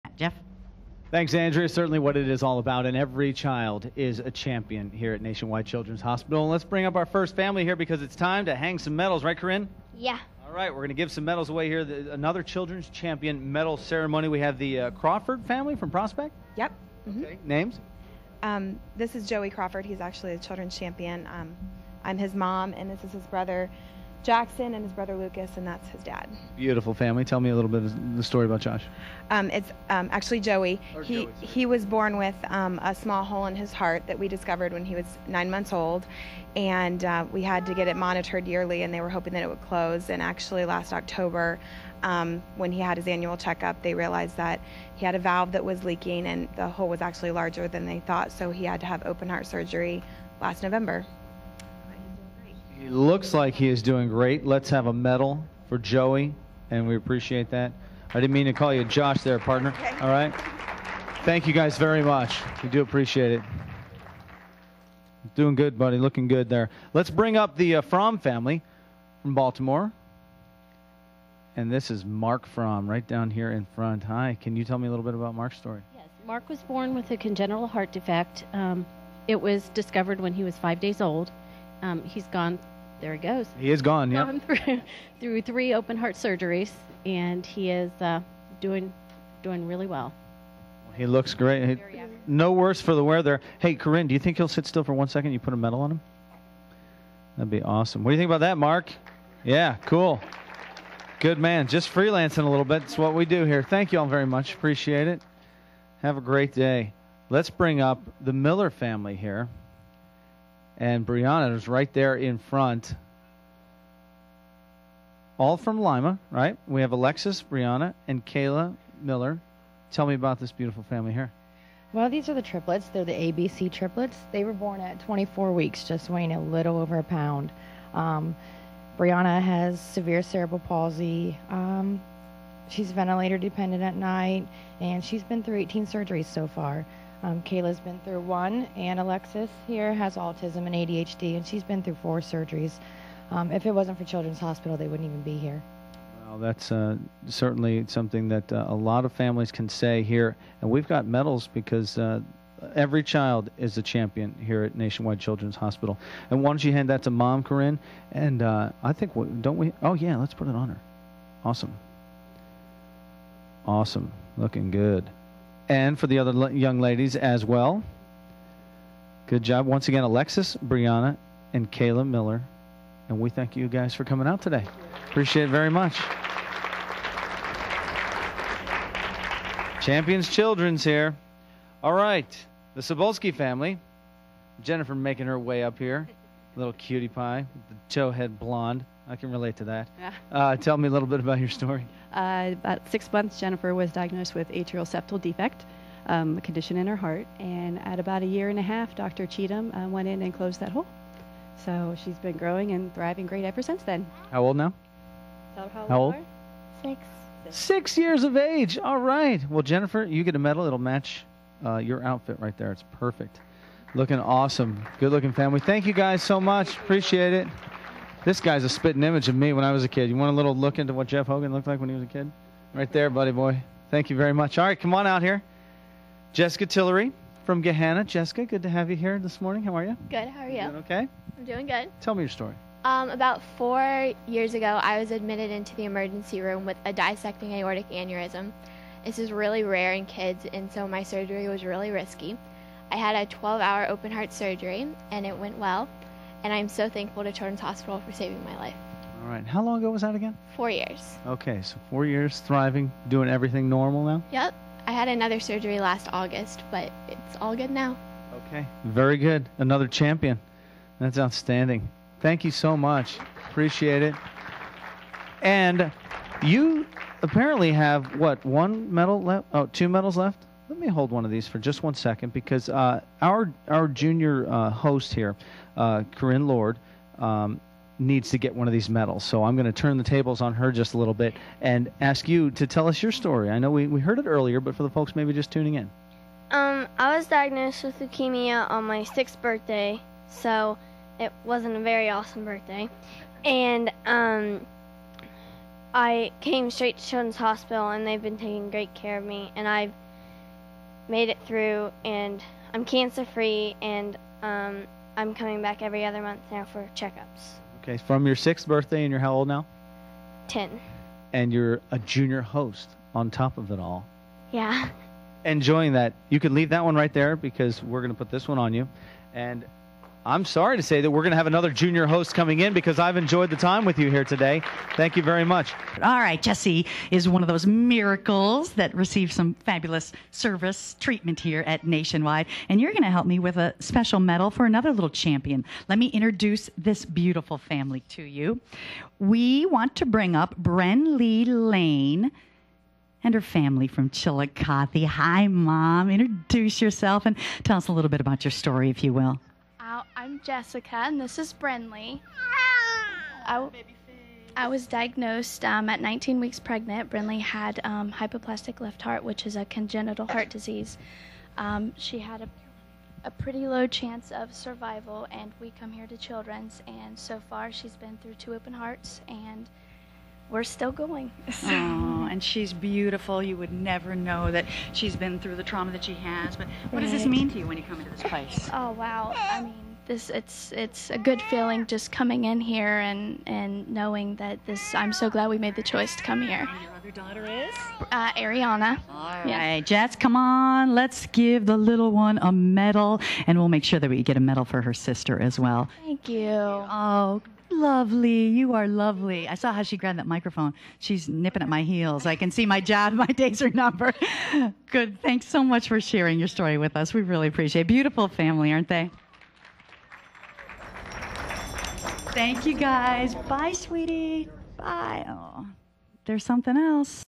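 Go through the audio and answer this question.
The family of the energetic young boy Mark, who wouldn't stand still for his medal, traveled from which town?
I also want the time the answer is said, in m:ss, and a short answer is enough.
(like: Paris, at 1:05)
Baltimore, at 1:09.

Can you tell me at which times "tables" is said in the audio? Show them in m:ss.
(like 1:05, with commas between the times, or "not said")
4:40.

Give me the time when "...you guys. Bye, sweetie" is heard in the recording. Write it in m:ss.
6:52.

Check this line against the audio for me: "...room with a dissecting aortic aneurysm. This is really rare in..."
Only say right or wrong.
right.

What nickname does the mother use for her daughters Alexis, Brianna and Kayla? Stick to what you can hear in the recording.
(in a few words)
ABC triplets.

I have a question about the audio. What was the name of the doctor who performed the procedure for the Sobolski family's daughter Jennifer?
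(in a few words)
Dr. Cheatham.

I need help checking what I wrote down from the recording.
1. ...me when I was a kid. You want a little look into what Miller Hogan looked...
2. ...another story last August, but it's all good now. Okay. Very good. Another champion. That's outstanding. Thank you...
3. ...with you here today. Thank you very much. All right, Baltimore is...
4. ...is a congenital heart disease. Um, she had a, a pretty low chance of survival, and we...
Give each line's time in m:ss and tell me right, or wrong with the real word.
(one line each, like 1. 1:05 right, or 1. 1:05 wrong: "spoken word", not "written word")
1. 3:39 wrong: "Jeff", not "Miller"
2. 4:15 wrong: "surgery", not "story"
3. 5:23 wrong: "Jesse", not "Baltimore"
4. 5:59 right.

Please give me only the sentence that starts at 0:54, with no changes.
Let's have a medal for Joey, and we appreciate that.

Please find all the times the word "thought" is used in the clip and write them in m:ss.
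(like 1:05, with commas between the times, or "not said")
0:48.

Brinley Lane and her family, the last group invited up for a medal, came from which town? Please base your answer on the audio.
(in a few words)
Chillicothe.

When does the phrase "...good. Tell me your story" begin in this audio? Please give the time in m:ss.
3:51.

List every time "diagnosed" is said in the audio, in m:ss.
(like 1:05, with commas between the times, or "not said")
3:13, 4:47, 5:54.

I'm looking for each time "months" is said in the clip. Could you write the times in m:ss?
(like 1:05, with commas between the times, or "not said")
0:35, 3:13, 5:06.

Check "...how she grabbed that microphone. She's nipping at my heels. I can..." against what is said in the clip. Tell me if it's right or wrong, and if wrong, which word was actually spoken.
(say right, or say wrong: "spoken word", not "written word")
right.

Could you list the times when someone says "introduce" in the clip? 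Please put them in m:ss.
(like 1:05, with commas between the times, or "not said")
5:36, 5:46.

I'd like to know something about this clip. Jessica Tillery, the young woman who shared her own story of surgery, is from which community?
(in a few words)
Gahanna.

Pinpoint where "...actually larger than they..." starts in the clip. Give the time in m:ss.
0:47.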